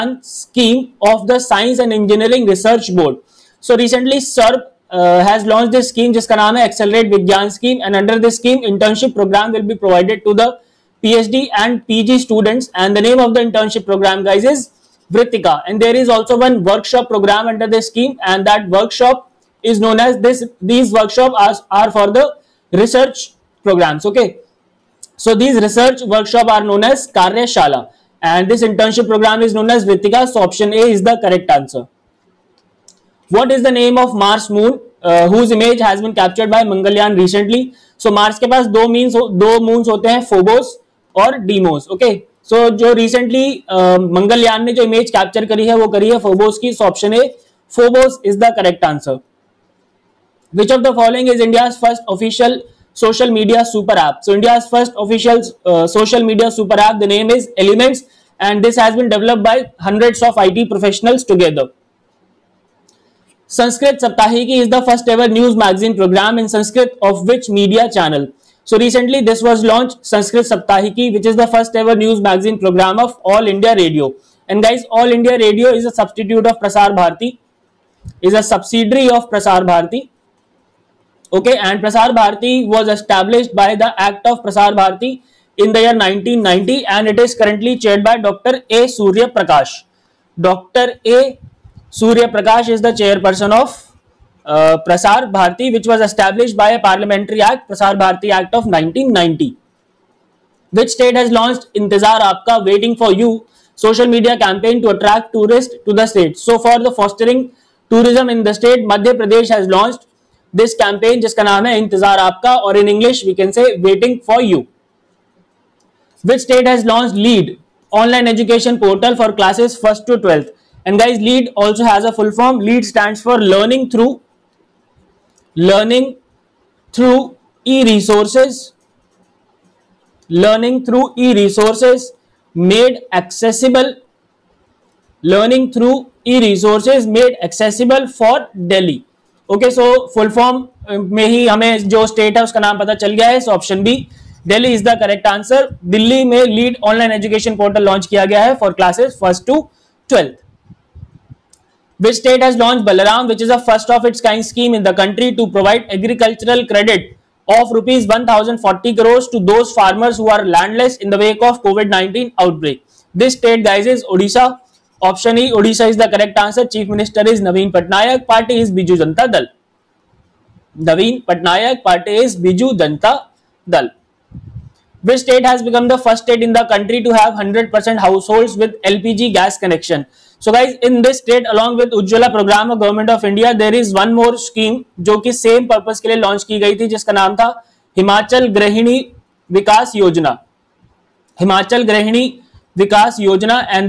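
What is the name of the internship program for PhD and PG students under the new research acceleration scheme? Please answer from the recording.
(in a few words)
Vritika.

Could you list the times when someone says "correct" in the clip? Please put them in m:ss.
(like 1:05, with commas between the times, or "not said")
0:31, 0:48.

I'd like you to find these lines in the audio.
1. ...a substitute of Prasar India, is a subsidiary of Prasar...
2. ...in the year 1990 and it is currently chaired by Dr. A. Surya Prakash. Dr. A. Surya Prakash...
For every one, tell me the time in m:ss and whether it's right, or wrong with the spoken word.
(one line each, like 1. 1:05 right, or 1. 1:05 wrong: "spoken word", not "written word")
1. 1:15 wrong: "Bharati", not "India"
2. 1:25 right.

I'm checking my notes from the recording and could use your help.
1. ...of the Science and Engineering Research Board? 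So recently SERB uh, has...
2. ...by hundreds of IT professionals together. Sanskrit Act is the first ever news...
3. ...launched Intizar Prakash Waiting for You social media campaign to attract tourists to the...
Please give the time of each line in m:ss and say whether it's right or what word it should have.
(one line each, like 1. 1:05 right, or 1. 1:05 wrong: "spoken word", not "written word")
1. 0:01 right
2. 0:59 wrong: "Saptahiki", not "Act"
3. 1:41 wrong: "Aapka", not "Prakash".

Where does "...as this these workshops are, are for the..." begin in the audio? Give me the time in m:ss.
0:20.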